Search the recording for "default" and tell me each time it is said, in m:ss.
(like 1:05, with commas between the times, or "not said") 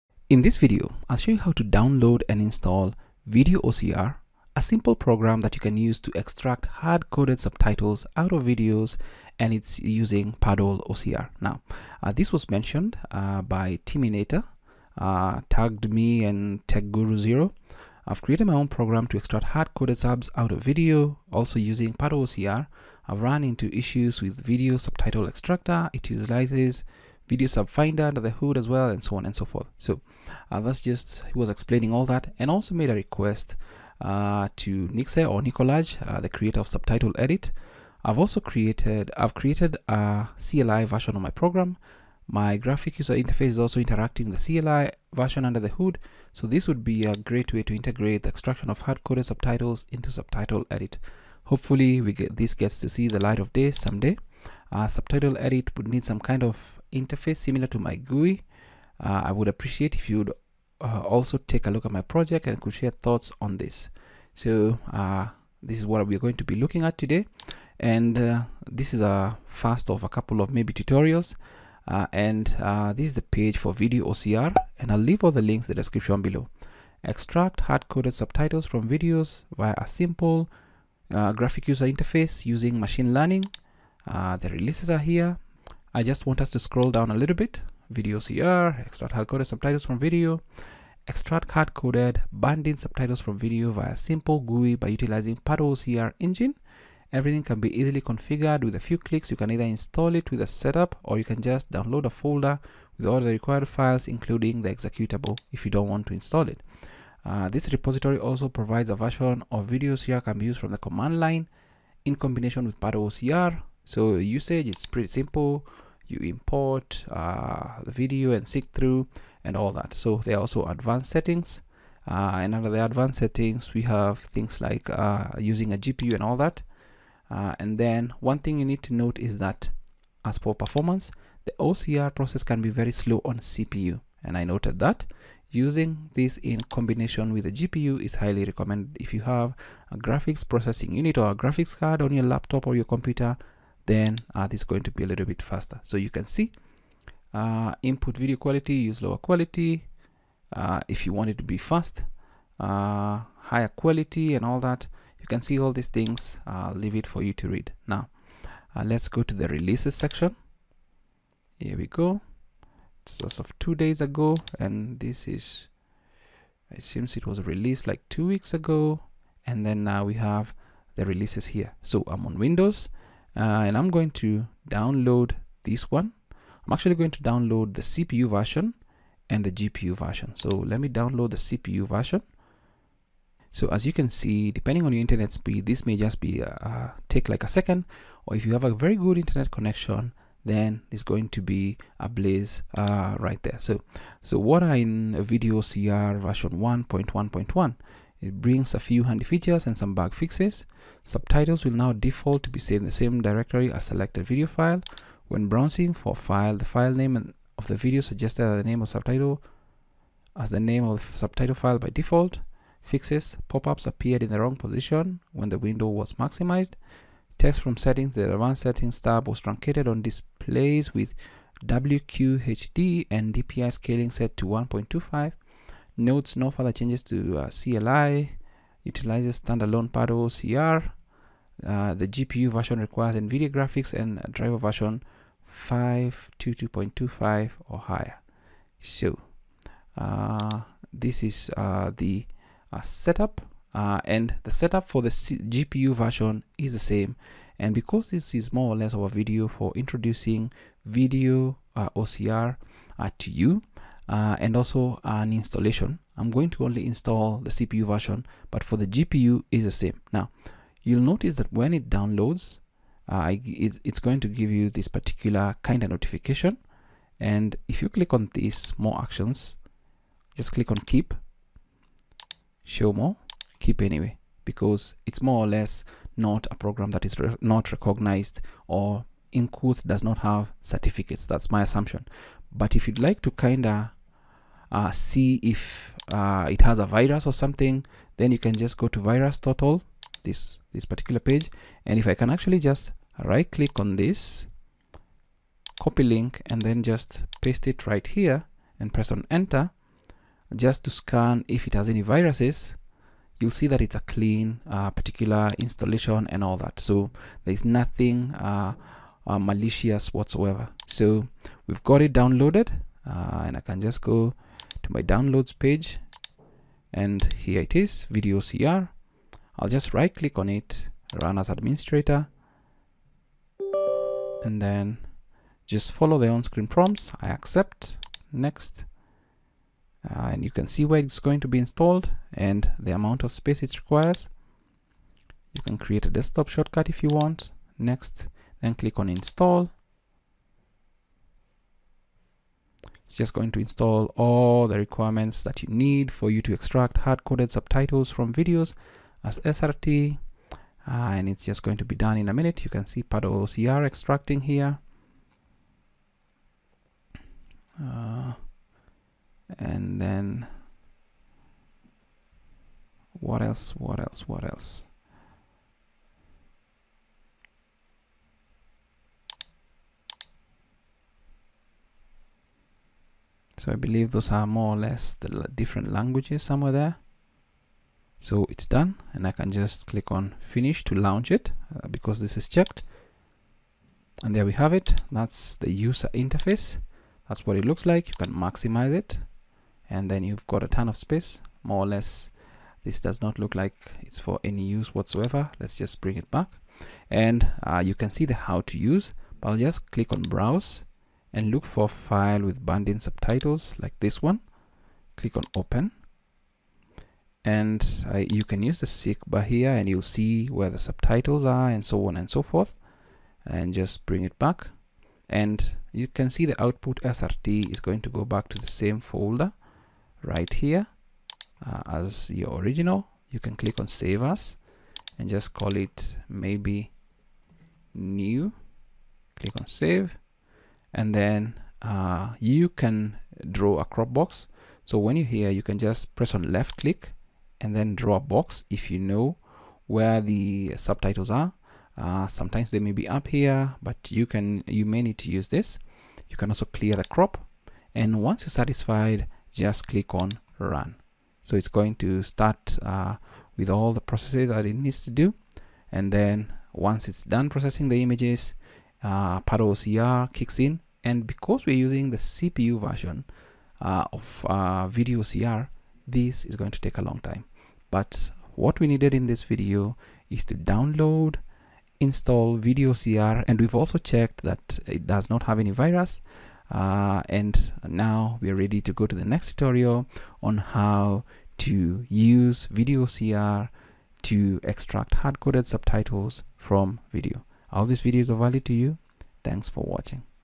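3:21, 3:31.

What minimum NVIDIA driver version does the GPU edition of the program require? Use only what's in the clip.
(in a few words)
522.25.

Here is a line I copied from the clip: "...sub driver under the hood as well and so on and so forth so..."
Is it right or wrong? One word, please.
wrong.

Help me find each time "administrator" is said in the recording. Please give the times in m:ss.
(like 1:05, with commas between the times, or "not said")
5:21.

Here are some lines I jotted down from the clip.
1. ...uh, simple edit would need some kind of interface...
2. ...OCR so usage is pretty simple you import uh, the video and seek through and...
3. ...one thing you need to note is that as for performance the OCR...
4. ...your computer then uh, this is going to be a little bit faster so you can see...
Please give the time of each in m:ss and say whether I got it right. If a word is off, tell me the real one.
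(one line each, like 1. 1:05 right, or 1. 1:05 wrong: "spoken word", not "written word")
1. 0:54 wrong: "subtitle", not "simple"
2. 1:53 right
3. 2:08 right
4. 2:22 right.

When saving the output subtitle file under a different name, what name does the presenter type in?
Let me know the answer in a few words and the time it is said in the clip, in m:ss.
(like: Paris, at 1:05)
new, at 7:07.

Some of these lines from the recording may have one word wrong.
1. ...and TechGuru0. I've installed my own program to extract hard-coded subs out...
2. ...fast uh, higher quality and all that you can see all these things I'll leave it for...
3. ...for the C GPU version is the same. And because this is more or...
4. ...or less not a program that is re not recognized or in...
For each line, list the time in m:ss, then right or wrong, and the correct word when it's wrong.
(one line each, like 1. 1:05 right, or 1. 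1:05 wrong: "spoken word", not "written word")
1. 0:16 wrong: "created", not "installed"
2. 2:31 right
3. 4:04 right
4. 4:35 right.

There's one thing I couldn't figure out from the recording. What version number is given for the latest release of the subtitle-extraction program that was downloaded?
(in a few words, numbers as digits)
1.1.1.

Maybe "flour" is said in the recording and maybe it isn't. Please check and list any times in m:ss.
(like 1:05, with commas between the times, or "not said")
not said.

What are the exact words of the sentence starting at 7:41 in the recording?
And because we're using the CPU version uh, of uh, video OCR, this is going to take a long time.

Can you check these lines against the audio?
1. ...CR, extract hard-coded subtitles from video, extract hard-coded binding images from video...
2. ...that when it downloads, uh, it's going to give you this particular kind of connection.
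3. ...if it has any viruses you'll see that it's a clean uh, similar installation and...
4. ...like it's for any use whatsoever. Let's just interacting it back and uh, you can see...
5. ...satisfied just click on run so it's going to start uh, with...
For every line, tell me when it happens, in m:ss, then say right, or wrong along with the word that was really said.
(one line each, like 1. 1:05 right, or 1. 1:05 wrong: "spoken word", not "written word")
1. 1:28 wrong: "subtitles", not "images"
2. 4:21 wrong: "notification", not "connection"
3. 5:01 wrong: "particular", not "similar"
4. 6:33 wrong: "bring", not "interacting"
5. 7:28 right.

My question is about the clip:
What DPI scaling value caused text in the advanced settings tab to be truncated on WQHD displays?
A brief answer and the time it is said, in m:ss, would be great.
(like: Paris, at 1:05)
1.25, at 3:44.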